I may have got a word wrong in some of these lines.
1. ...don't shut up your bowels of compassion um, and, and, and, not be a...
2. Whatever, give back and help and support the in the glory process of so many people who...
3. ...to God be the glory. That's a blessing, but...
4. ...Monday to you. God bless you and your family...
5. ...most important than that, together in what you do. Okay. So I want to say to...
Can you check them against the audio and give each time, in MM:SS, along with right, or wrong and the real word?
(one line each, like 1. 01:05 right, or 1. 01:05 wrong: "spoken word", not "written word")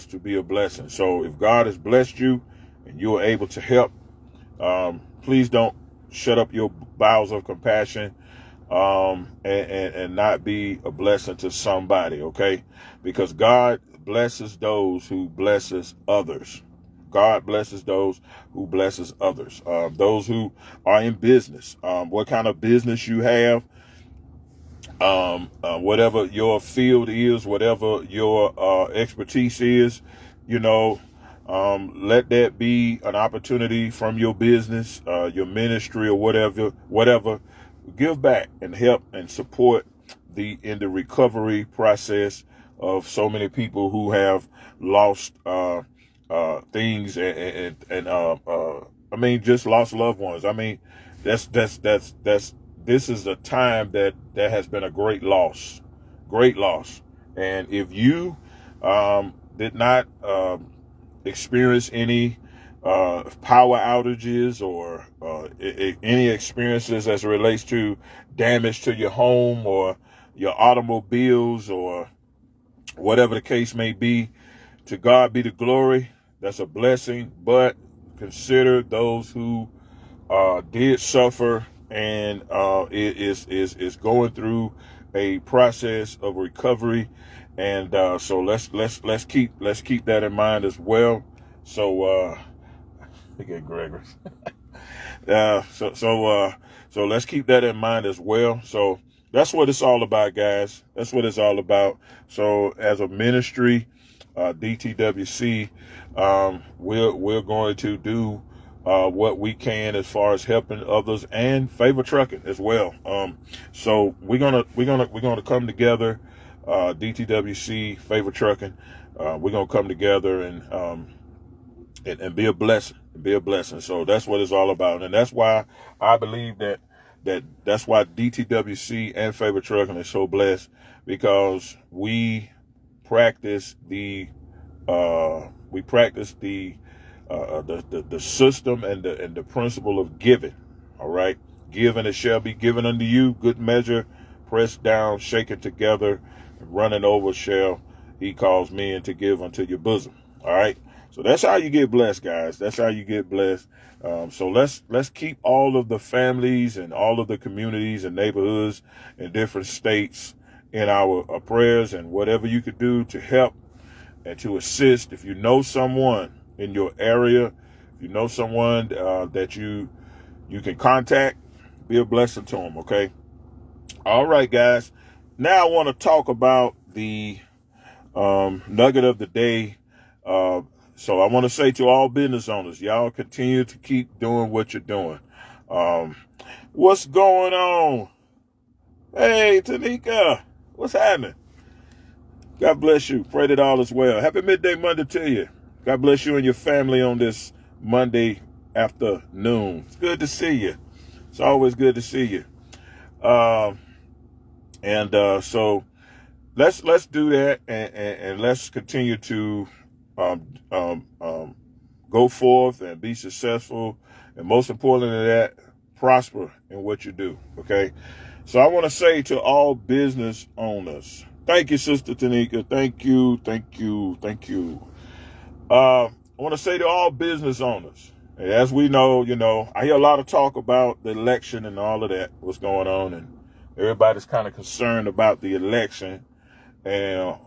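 1. 00:05 right
2. 00:36 wrong: "recovery", not "glory"
3. 01:14 right
4. 03:14 right
5. 03:34 wrong: "prosper", not "together".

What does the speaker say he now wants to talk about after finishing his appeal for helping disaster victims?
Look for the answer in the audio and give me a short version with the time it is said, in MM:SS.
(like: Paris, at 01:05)
nugget of the day, at 02:58.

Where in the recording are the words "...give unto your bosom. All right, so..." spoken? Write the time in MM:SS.
02:29.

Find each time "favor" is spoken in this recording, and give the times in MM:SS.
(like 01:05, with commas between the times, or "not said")
01:51, 01:57, 02:09.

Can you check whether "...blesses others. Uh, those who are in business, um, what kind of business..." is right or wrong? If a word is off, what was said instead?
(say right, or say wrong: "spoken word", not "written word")
right.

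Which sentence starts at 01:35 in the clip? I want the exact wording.
uh, so so uh, so let's keep that in mind as well.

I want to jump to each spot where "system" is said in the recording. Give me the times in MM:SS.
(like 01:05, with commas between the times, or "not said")
02:18.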